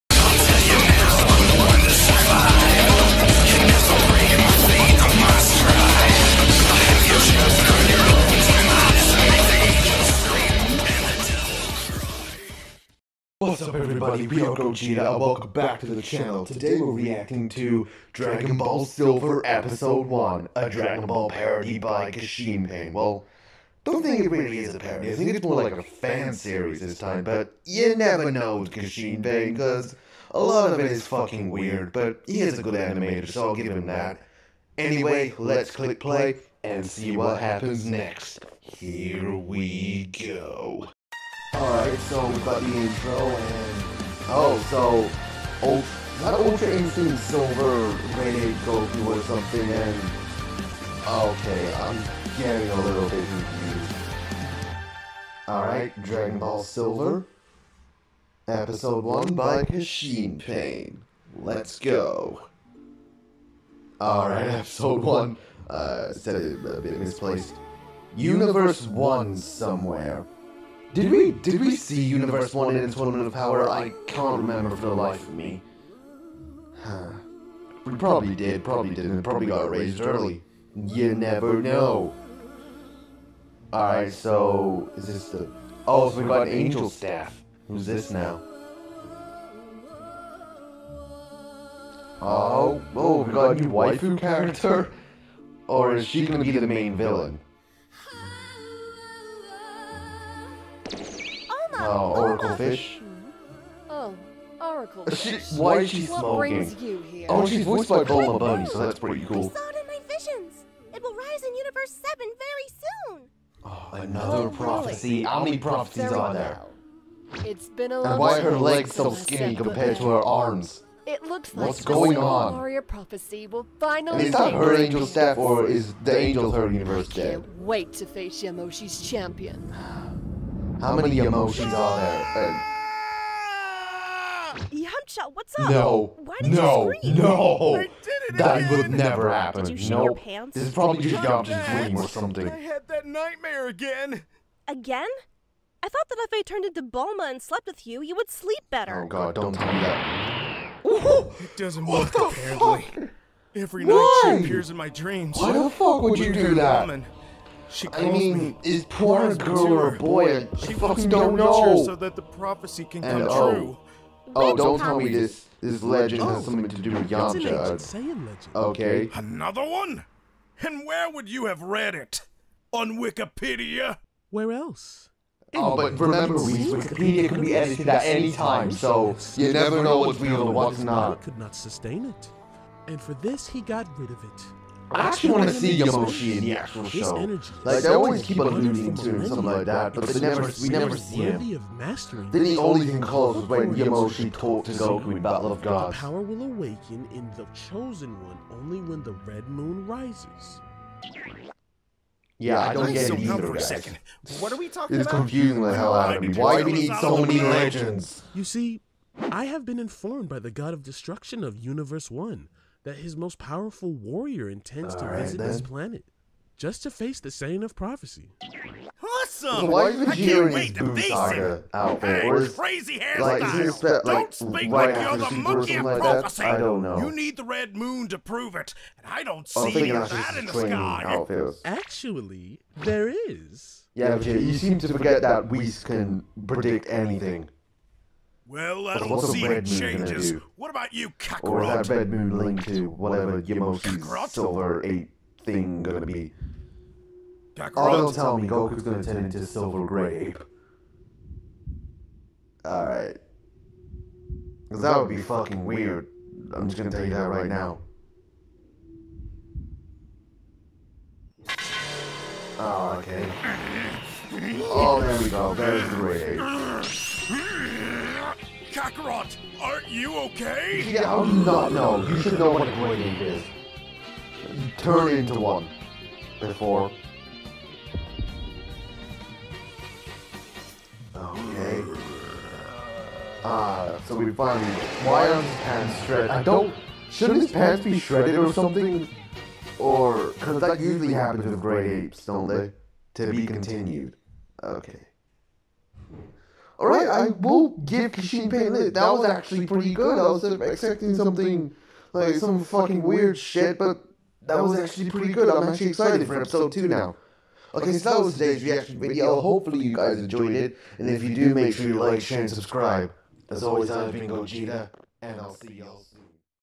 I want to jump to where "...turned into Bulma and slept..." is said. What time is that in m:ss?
2:26.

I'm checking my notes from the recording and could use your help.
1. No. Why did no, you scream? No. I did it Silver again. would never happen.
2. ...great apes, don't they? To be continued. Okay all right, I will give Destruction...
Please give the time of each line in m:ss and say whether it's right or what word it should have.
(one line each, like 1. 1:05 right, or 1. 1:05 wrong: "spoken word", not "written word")
1. 2:15 wrong: "That", not "Silver"
2. 4:51 wrong: "Kishin", not "Destruction".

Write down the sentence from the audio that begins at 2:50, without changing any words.
And where would you have read it?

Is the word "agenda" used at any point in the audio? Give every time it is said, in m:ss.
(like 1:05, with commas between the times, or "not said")
not said.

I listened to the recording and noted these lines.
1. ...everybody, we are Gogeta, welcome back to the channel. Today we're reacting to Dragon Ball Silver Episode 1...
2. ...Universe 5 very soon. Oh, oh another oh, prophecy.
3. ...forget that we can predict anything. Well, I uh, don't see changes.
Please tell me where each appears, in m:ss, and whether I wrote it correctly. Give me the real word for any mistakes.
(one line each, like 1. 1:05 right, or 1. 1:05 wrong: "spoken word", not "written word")
1. 0:13 right
2. 1:51 wrong: "7", not "5"
3. 3:54 right.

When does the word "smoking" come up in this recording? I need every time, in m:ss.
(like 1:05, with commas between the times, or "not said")
1:46.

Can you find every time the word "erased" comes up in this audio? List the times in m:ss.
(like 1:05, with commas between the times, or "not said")
1:19.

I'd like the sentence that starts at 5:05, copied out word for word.
I'm actually excited for episode two now.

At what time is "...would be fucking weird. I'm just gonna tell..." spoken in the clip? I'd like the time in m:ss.
4:14.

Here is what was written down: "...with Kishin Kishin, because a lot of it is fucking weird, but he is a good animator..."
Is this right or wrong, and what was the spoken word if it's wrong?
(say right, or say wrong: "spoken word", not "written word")
wrong: "Pain", not "Kishin".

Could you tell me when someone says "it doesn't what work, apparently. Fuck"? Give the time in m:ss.
2:30.